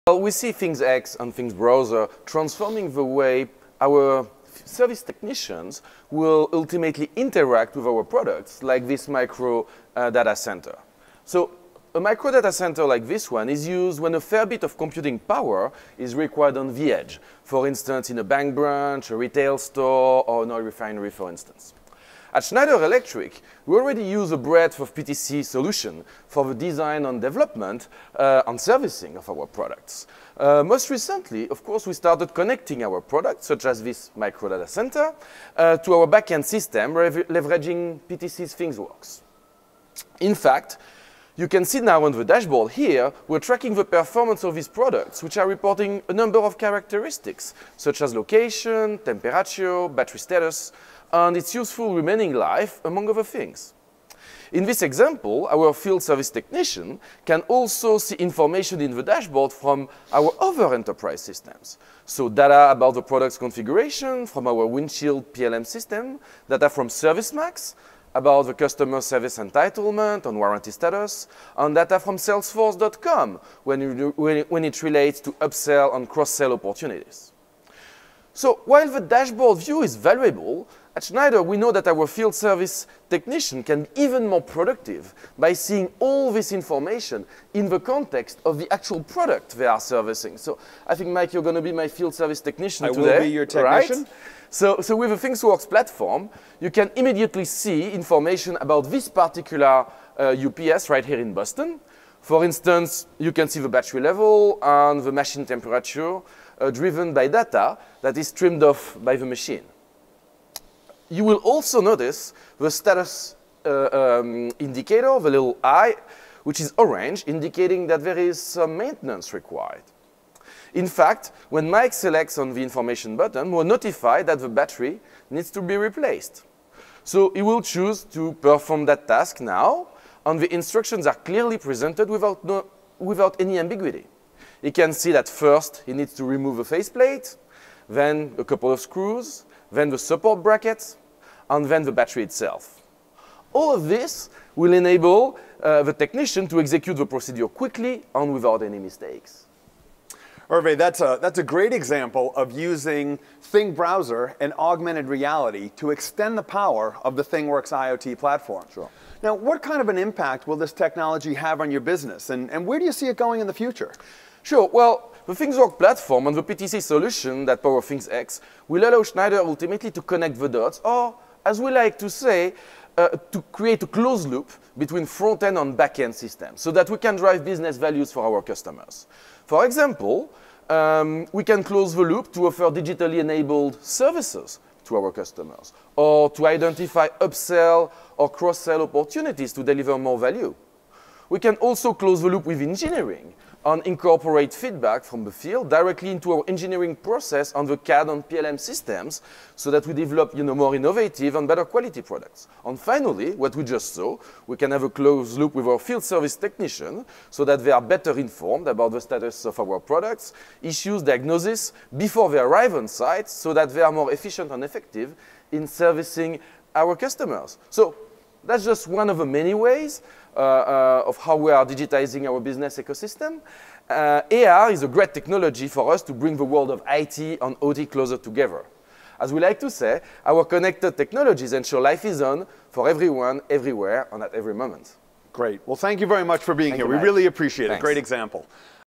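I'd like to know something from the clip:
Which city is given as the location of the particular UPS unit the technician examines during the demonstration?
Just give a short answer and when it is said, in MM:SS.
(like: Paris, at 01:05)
Boston, at 01:41.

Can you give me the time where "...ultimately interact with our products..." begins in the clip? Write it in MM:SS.
00:06.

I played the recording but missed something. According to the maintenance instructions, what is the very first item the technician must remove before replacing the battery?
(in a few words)
A faceplate.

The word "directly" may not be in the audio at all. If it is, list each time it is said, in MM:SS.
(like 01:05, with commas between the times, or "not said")
03:15.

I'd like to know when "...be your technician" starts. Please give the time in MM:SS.
01:33.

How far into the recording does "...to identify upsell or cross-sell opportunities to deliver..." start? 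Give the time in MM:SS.
03:06.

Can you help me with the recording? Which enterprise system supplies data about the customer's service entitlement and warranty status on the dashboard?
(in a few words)
ServiceMax.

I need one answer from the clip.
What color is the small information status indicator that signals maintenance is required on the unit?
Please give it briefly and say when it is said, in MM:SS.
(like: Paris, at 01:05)
Orange, at 01:56.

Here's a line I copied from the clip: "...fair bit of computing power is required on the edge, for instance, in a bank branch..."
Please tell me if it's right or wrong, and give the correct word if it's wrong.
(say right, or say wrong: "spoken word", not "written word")
right.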